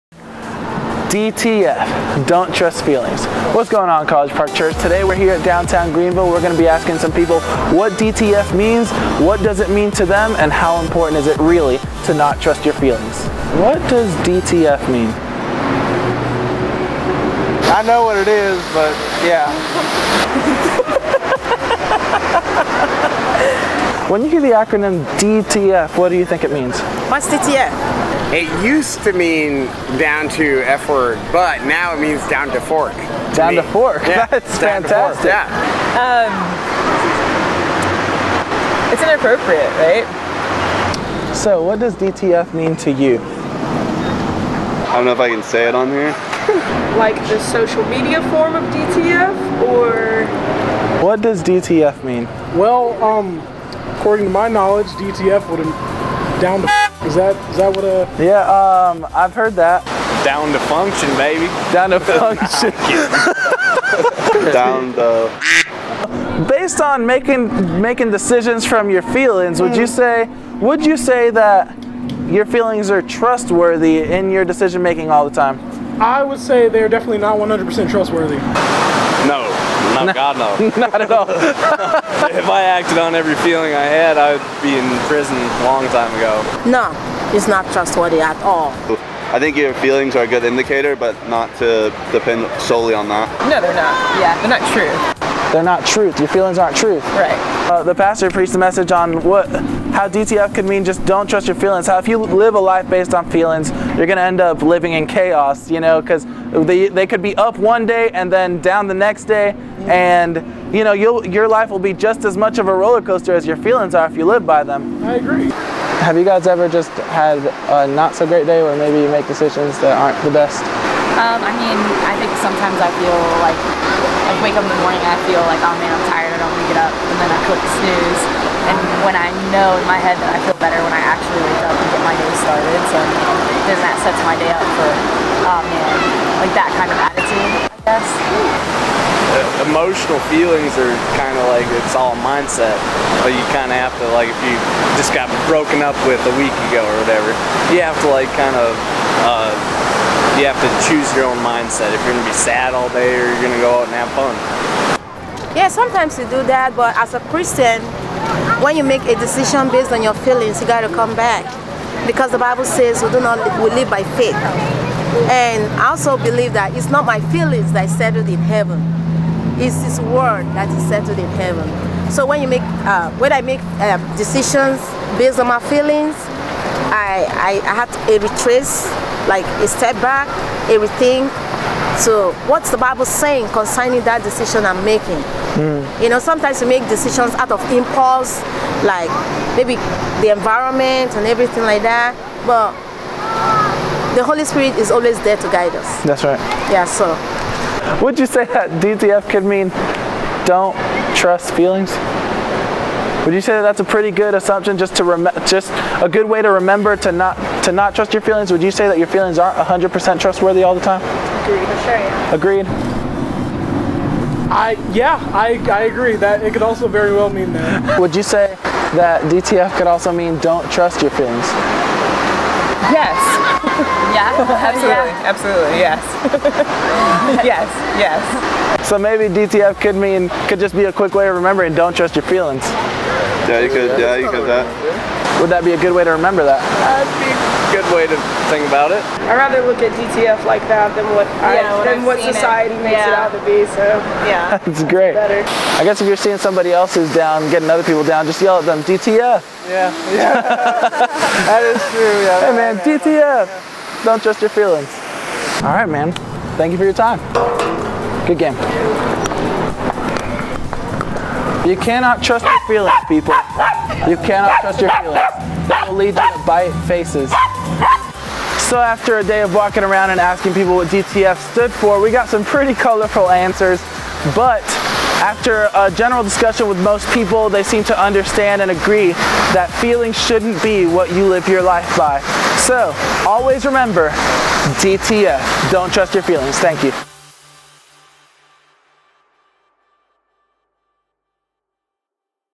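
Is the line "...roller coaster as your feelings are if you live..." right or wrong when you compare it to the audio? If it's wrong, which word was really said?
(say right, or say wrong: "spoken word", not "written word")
right.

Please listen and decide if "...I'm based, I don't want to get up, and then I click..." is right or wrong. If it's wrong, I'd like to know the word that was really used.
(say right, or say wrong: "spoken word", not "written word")
wrong: "tired", not "based".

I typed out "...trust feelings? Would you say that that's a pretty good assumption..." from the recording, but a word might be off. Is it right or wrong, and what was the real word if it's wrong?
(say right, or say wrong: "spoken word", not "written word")
right.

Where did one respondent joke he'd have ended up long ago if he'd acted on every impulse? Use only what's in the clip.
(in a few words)
prison.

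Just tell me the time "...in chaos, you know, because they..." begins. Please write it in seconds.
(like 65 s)
104 s.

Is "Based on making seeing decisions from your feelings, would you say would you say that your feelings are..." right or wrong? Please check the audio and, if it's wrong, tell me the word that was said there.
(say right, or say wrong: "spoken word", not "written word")
wrong: "making", not "seeing".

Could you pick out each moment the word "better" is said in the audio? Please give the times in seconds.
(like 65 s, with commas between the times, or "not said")
130 s, 245 s.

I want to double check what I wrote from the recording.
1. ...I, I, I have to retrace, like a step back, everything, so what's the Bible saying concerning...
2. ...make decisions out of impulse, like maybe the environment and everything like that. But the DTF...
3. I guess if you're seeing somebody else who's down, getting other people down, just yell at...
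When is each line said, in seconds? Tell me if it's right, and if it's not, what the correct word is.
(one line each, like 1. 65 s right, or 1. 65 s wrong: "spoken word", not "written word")
1. 176 s right
2. 186 s wrong: "Holy", not "DTF"
3. 245 s right.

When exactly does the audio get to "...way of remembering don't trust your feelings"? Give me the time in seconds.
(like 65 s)
231 s.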